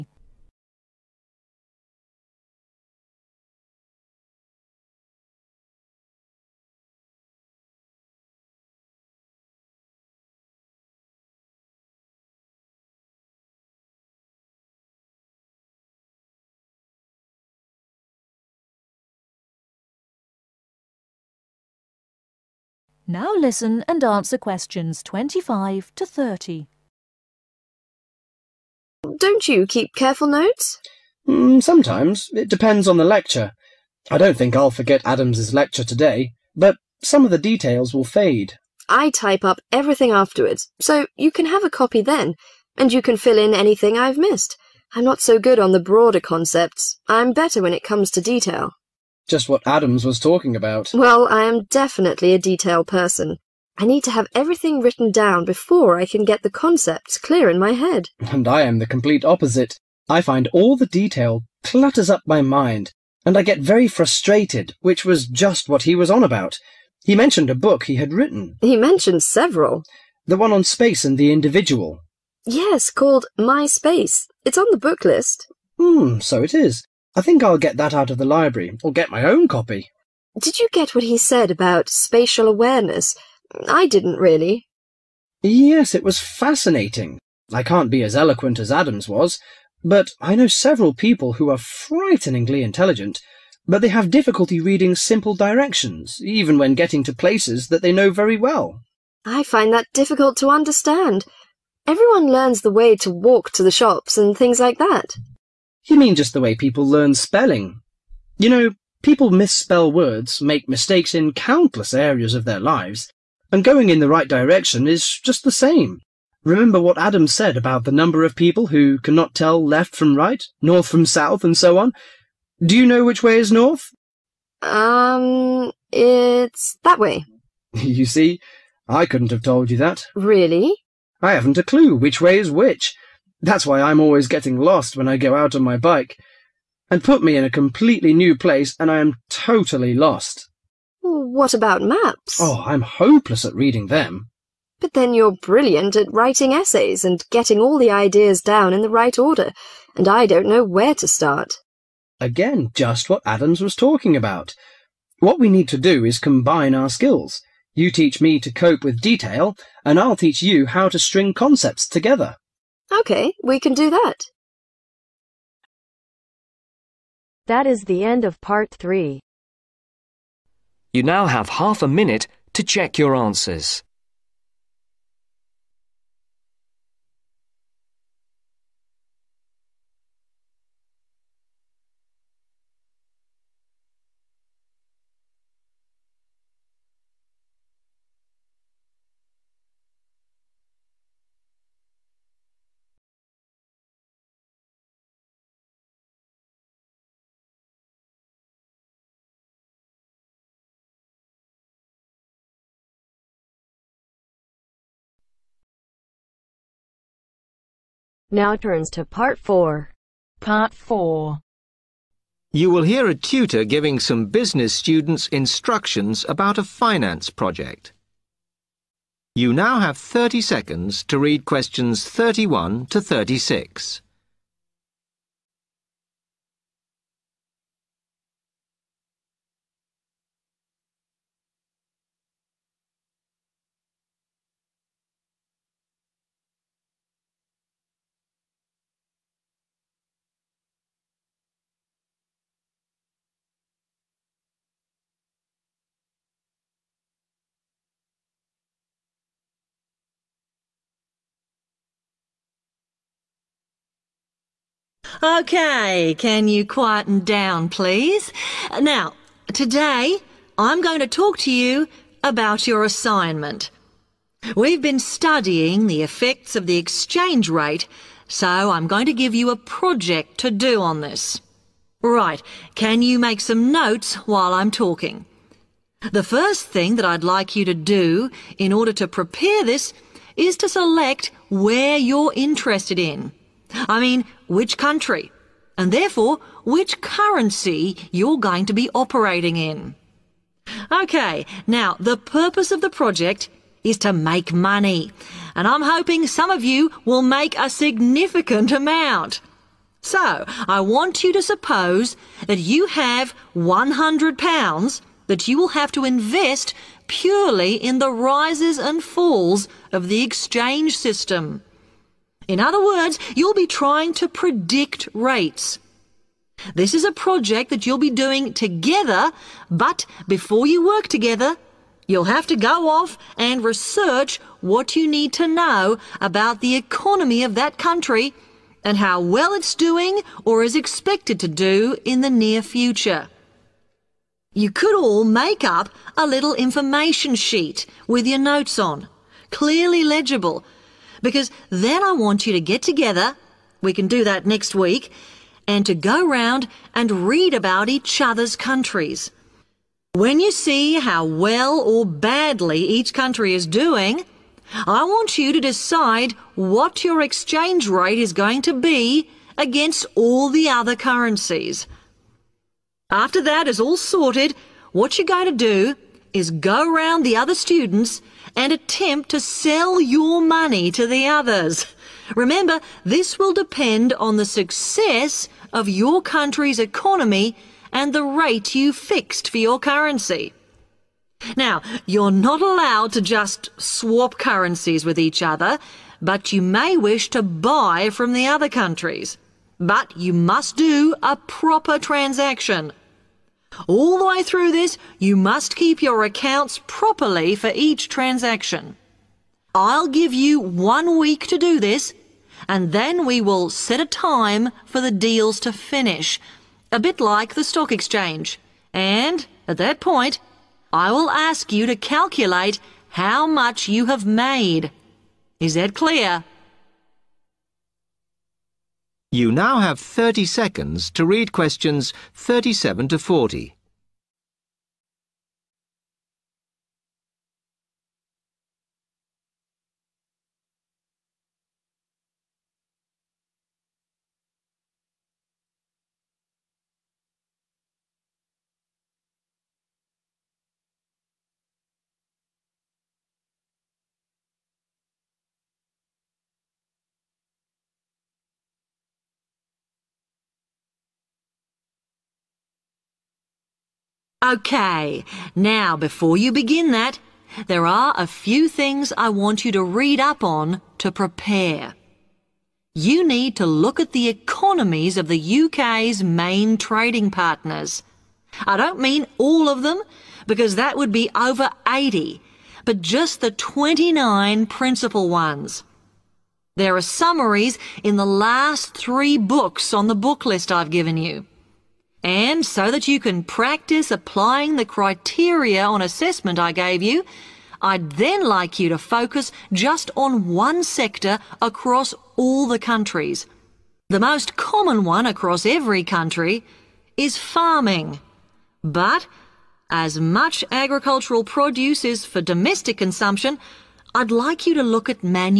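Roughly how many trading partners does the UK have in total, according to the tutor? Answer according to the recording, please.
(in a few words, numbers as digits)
over 80.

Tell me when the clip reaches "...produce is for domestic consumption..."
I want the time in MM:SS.
08:21.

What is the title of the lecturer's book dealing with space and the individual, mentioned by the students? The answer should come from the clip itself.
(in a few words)
My Space.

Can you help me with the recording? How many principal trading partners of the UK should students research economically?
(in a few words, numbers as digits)
29.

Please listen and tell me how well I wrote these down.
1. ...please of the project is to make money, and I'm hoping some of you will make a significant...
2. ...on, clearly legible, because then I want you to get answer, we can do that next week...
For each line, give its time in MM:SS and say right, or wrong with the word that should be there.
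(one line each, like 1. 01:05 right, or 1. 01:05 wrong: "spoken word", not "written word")
1. 04:52 wrong: "purpose", not "please"
2. 05:38 wrong: "together", not "answer".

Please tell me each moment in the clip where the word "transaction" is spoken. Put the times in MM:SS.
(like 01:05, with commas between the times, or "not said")
06:31, 06:38.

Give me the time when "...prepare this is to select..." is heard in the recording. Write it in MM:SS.
04:39.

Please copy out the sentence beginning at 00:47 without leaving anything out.
I'm better when it comes to detail just what Adams was talking about.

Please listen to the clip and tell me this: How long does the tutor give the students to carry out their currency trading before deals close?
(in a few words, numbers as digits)
one week.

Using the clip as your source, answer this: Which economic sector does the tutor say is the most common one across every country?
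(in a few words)
farming.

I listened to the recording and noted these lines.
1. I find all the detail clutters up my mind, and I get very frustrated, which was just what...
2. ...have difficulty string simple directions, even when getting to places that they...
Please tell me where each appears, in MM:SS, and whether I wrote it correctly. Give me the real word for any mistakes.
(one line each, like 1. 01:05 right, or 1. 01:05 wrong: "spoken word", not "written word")
1. 01:00 right
2. 01:33 wrong: "reading", not "string".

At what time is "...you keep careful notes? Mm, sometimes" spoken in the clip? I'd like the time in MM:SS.
00:29.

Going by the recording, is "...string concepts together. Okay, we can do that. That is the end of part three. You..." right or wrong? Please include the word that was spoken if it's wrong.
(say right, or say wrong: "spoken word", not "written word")
right.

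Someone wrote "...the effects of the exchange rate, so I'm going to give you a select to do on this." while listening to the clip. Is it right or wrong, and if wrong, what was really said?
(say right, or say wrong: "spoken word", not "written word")
wrong: "project", not "select".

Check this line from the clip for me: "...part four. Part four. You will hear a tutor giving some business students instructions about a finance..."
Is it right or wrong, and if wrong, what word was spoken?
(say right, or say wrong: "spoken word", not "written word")
right.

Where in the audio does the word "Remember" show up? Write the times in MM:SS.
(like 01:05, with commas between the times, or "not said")
01:56, 06:12.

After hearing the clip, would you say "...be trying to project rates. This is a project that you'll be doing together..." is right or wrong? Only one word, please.
wrong.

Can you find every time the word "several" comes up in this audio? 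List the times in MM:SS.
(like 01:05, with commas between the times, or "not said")
01:09, 01:30.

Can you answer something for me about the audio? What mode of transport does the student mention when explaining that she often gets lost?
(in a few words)
bike.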